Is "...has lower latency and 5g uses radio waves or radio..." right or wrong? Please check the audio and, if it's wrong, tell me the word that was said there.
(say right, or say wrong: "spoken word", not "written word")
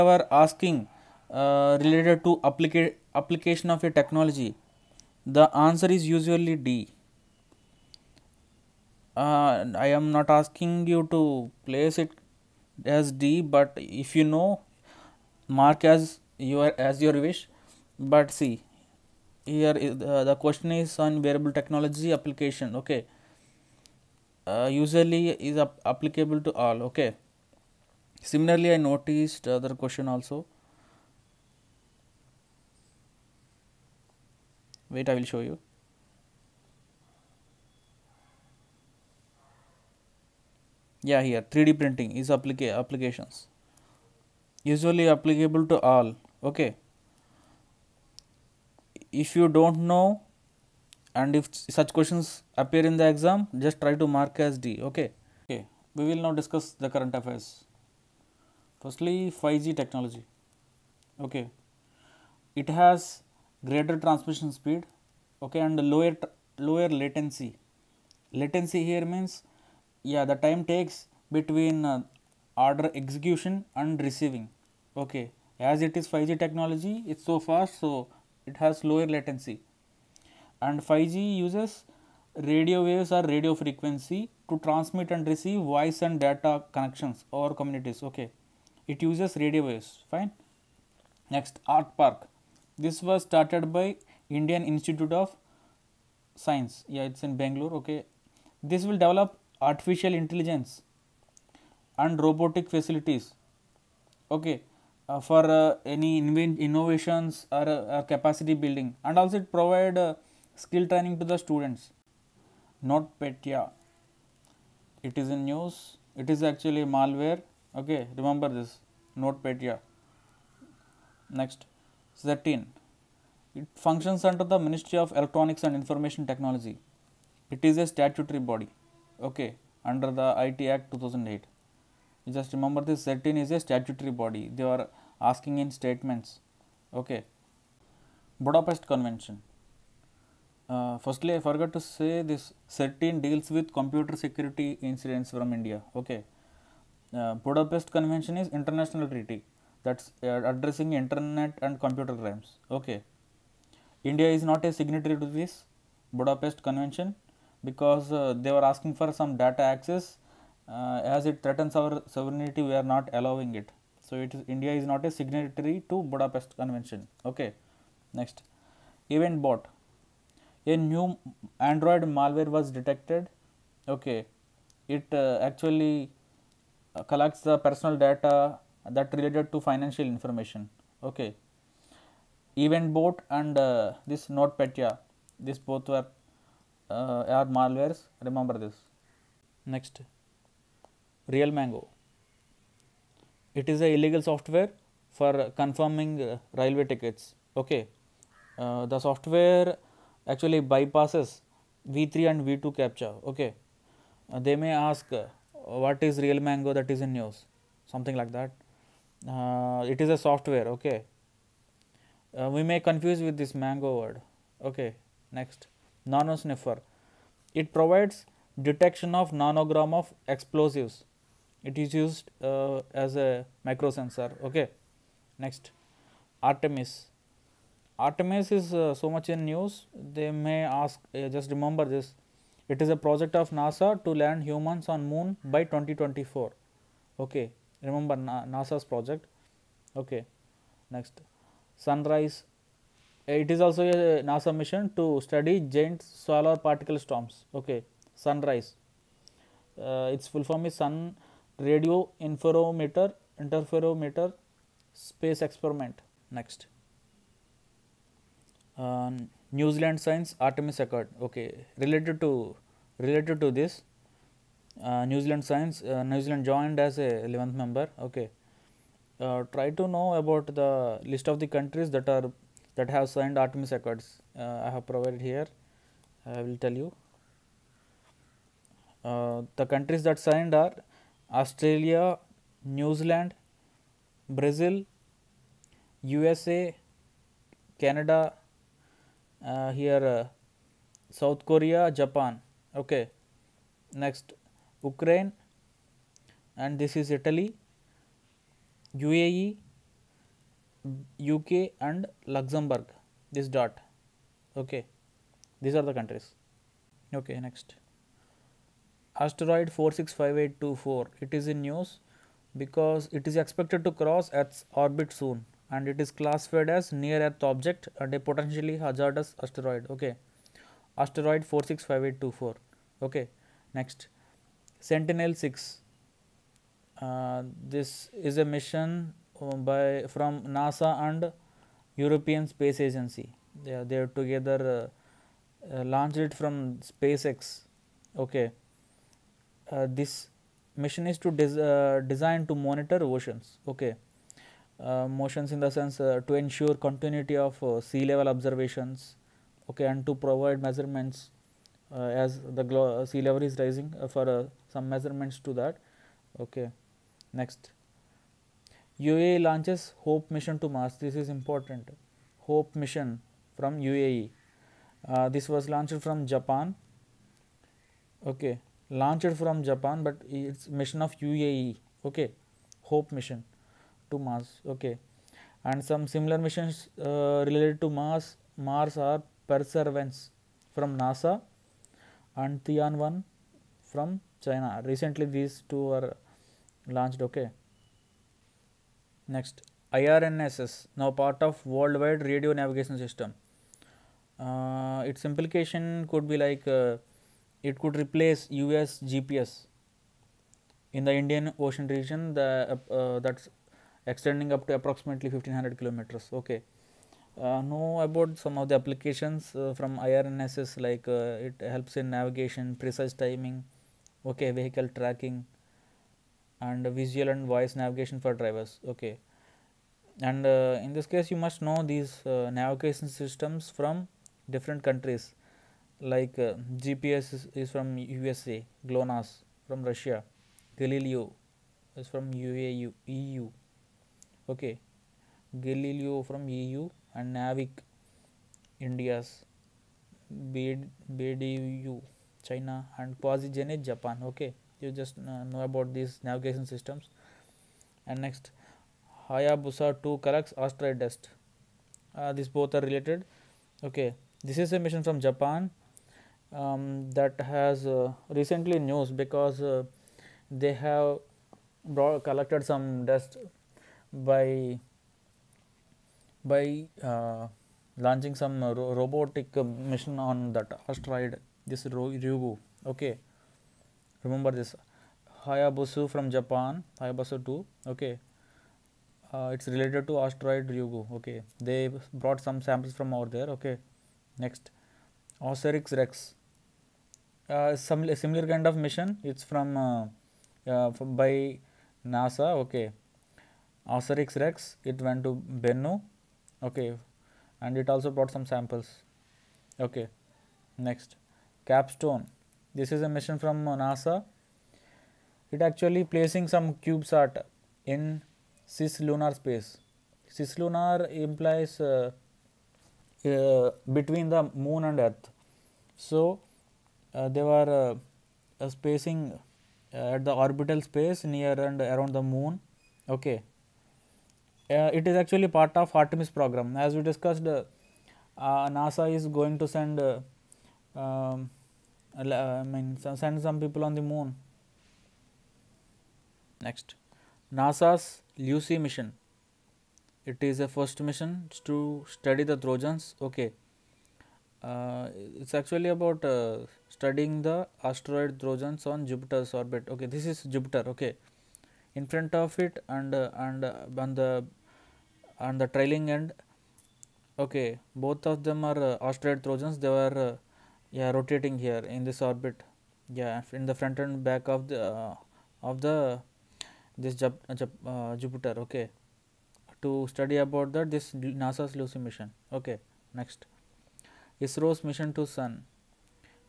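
right.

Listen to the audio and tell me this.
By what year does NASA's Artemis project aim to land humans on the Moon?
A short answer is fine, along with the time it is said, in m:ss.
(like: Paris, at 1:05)
2024, at 3:55.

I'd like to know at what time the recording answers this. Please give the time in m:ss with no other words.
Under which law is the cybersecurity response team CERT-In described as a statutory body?
2:10.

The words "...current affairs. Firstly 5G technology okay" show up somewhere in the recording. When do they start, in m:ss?
0:56.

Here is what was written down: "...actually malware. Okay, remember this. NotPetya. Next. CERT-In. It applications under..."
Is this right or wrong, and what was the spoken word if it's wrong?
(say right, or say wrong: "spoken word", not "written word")
wrong: "functions", not "applications".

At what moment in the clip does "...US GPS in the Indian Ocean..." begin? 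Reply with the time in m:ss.
6:38.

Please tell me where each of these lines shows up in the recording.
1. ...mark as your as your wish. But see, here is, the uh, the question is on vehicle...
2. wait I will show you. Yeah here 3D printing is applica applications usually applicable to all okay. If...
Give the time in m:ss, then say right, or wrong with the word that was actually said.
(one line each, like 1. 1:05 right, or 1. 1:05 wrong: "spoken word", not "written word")
1. 0:15 wrong: "wearable", not "vehicle"
2. 0:34 right.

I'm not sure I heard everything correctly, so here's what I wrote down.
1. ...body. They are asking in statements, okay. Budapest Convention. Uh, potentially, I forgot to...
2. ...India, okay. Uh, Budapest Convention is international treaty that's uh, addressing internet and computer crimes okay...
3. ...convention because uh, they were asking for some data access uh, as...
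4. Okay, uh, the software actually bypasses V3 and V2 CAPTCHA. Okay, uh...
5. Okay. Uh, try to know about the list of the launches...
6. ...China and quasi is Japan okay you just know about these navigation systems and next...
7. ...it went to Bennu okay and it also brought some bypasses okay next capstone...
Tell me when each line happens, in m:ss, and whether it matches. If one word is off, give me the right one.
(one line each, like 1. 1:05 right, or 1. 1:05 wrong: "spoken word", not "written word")
1. 2:14 wrong: "firstly", not "potentially"
2. 2:25 right
3. 2:36 right
4. 3:17 right
5. 4:27 wrong: "countries", not "launches"
6. 7:22 right
7. 8:14 wrong: "samples", not "bypasses".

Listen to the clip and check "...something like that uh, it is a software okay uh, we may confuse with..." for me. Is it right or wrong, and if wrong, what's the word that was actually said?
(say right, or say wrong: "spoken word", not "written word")
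right.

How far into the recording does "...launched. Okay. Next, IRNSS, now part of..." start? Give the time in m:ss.
6:26.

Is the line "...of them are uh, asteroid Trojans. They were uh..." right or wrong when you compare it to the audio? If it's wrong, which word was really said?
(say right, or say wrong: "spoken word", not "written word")
right.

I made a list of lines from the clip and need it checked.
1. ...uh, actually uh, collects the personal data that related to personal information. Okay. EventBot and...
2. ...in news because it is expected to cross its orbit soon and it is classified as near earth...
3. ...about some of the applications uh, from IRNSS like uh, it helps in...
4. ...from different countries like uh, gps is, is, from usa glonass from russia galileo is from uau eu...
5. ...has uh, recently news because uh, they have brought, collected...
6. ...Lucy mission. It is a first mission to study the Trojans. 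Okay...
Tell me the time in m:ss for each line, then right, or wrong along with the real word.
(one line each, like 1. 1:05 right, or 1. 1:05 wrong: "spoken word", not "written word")
1. 2:55 wrong: "financial", not "personal"
2. 5:11 right
3. 6:47 right
4. 7:03 right
5. 7:37 right
6. 8:58 right.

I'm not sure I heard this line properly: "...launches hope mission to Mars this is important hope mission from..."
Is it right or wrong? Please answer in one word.
right.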